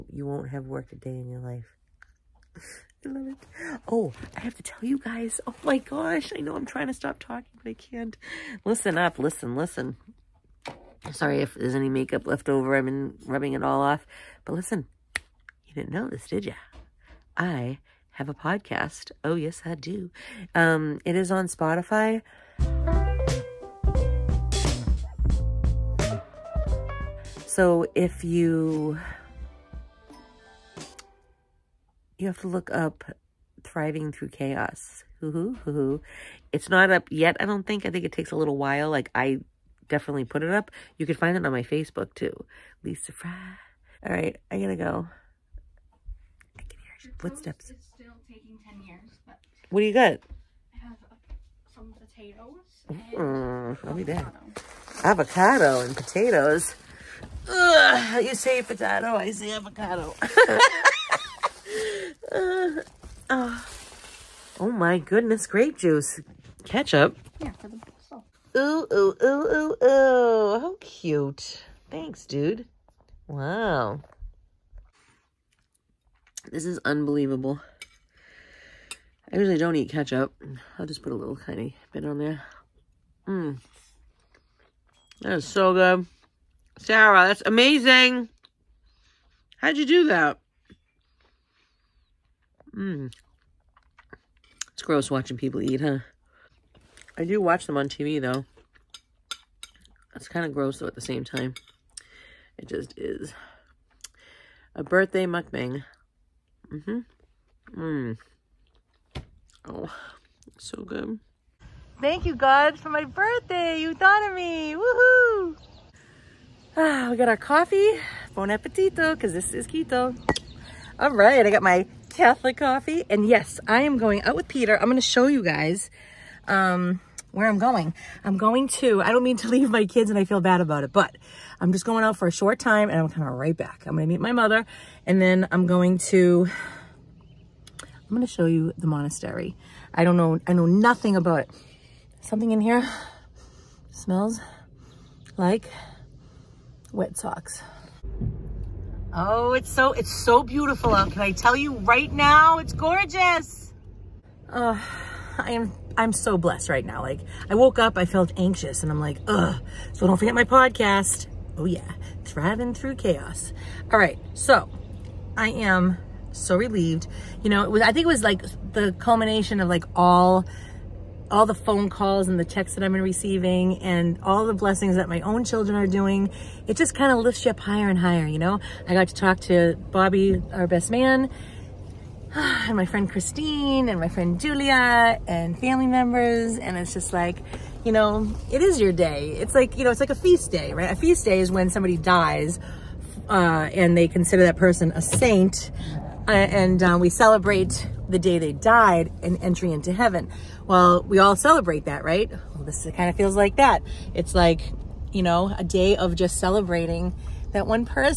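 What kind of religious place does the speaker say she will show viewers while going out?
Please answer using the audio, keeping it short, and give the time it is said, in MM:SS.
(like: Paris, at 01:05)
monastery, at 02:18.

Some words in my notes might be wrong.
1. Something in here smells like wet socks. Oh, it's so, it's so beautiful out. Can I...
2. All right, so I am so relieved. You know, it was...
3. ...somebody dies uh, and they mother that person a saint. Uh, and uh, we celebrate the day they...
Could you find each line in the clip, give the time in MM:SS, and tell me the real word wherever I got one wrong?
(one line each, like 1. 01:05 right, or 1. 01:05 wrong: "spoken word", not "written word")
1. 02:22 right
2. 02:43 right
3. 03:11 wrong: "consider", not "mother".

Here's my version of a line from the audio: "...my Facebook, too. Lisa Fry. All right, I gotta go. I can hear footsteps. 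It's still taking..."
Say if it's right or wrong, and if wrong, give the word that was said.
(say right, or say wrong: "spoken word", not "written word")
right.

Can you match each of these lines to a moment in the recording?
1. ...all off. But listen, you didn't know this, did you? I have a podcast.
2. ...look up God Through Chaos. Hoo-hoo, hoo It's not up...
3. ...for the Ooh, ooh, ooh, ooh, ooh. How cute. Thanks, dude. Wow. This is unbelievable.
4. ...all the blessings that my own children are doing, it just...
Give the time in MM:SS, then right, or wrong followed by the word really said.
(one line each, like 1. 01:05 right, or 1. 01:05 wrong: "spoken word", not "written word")
1. 00:13 right
2. 00:32 wrong: "Thriving", not "God"
3. 01:07 right
4. 02:54 right.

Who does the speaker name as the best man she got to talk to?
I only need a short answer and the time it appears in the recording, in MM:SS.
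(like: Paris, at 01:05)
Bobby, at 02:59.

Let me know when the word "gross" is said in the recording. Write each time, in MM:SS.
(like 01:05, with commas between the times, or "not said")
01:34, 01:40.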